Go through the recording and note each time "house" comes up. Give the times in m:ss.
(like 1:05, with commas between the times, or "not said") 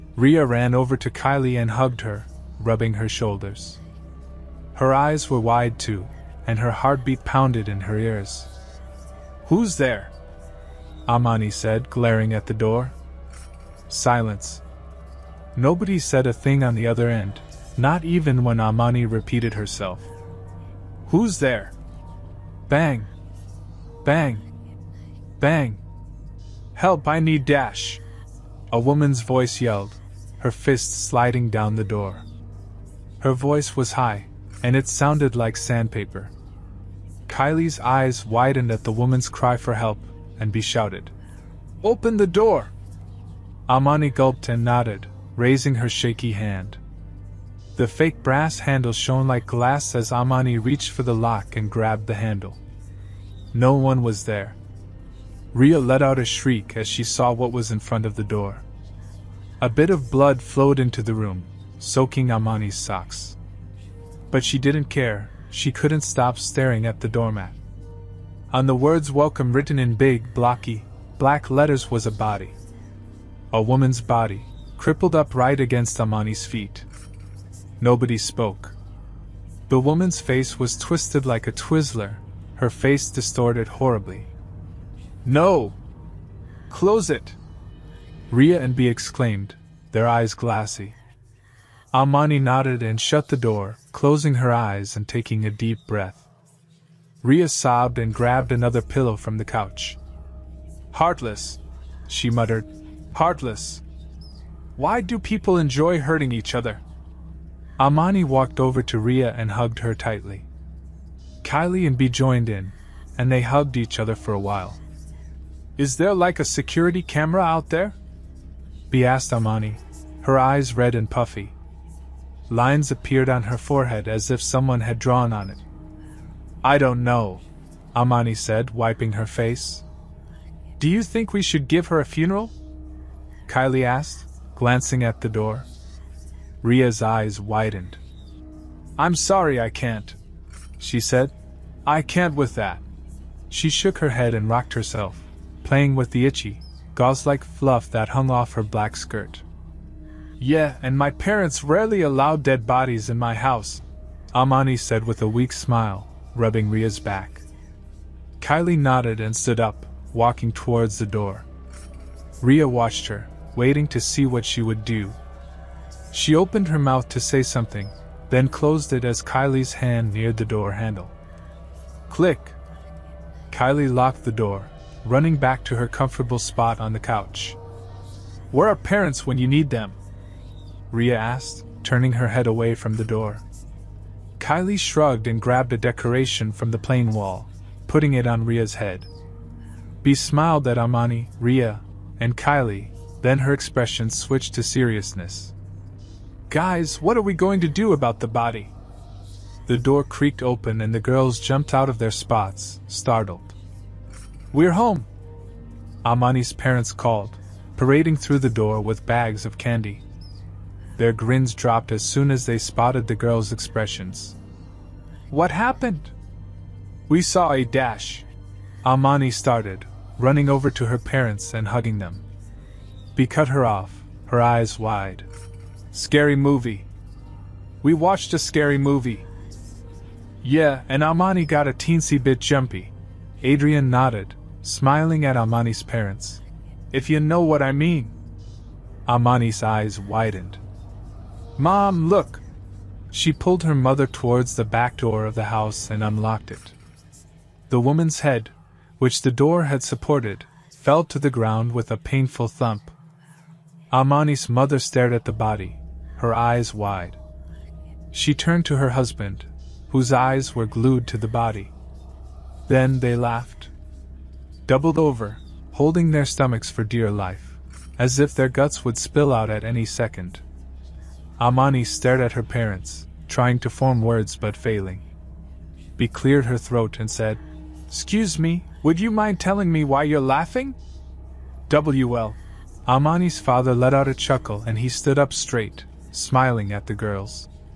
2:33, 4:05.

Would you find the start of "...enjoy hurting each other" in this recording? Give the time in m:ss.
1:45.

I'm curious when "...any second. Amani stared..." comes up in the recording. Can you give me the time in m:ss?
4:29.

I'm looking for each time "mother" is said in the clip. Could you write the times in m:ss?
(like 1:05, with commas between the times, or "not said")
4:03, 4:14.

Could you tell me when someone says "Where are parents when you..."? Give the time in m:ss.
2:58.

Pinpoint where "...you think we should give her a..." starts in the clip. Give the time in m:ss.
2:10.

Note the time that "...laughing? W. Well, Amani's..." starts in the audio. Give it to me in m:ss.
4:40.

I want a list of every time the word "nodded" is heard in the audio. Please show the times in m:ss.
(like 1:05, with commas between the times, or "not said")
0:44, 1:32, 2:38, 3:53.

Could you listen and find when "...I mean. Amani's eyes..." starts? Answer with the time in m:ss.
3:57.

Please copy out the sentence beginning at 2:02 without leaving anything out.
Lines appeared on her forehead as if someone had drawn on it.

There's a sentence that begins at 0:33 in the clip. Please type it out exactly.
Her voice was high, and it sounded like sandpaper.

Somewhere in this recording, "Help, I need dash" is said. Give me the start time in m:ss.
0:26.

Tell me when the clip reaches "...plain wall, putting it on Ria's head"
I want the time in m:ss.
3:06.